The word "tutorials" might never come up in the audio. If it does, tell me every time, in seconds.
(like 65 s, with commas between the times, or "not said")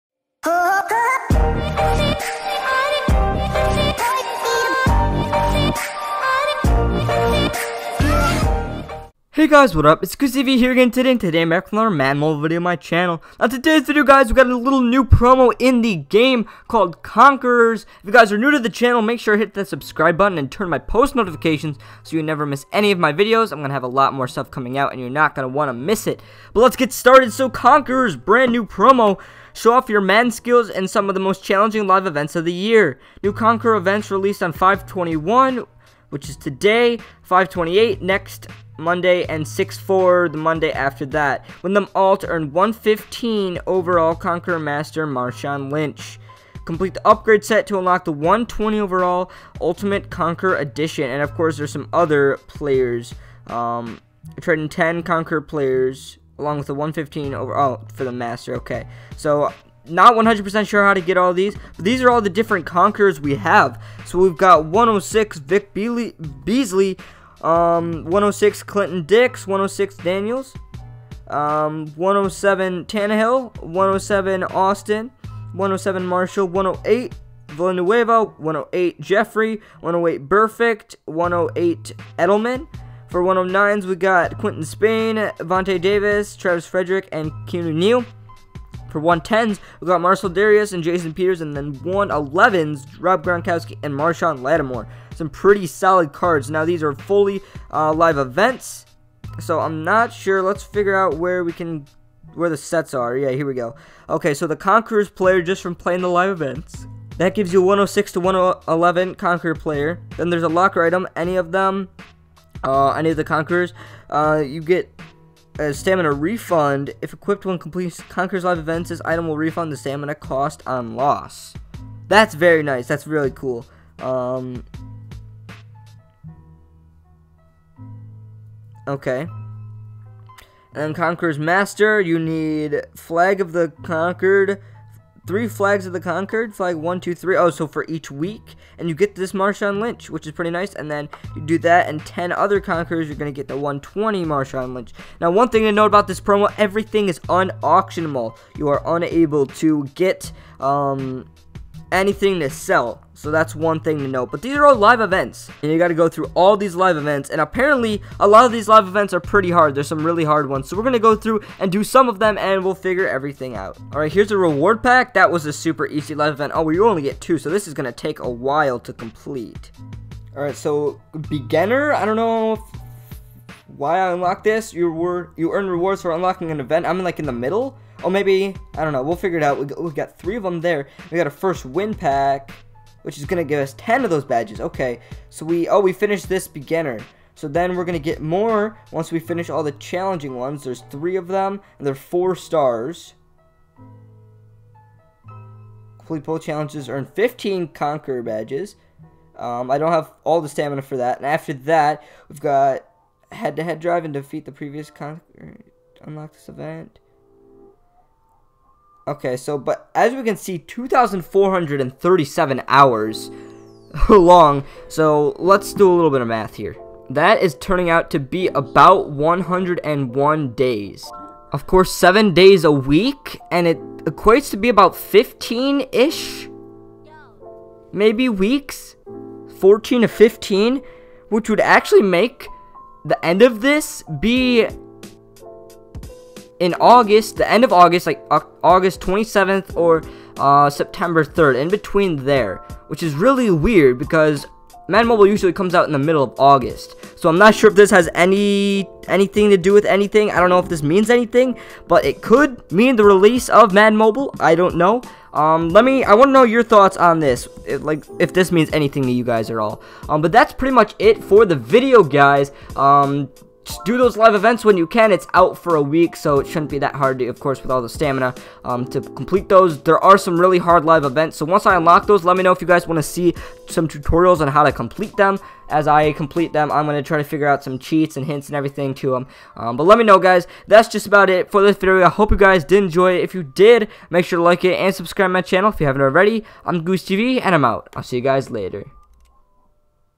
273 s.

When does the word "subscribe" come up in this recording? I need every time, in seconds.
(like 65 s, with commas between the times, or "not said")
19 s, 284 s.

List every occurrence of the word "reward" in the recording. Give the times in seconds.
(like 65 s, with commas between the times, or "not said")
164 s, 175 s.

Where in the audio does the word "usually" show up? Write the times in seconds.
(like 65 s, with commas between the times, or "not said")
245 s.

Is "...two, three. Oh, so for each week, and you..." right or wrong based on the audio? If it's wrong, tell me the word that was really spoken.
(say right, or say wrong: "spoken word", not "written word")
right.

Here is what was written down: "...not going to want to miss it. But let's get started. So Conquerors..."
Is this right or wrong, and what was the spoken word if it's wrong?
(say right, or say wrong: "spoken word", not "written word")
right.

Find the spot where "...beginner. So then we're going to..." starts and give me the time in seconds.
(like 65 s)
186 s.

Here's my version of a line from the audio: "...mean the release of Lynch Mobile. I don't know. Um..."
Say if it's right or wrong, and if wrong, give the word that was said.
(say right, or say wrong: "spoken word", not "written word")
wrong: "Madden", not "Lynch".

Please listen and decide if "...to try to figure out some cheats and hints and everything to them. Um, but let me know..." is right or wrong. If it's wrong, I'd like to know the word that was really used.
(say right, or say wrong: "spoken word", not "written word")
right.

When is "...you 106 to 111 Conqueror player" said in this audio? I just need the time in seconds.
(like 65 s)
107 s.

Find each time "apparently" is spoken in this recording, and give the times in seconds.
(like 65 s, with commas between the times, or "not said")
157 s.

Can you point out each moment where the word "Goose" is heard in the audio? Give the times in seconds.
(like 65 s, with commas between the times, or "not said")
10 s, 286 s.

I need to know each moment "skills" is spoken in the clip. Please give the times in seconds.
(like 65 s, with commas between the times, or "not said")
30 s.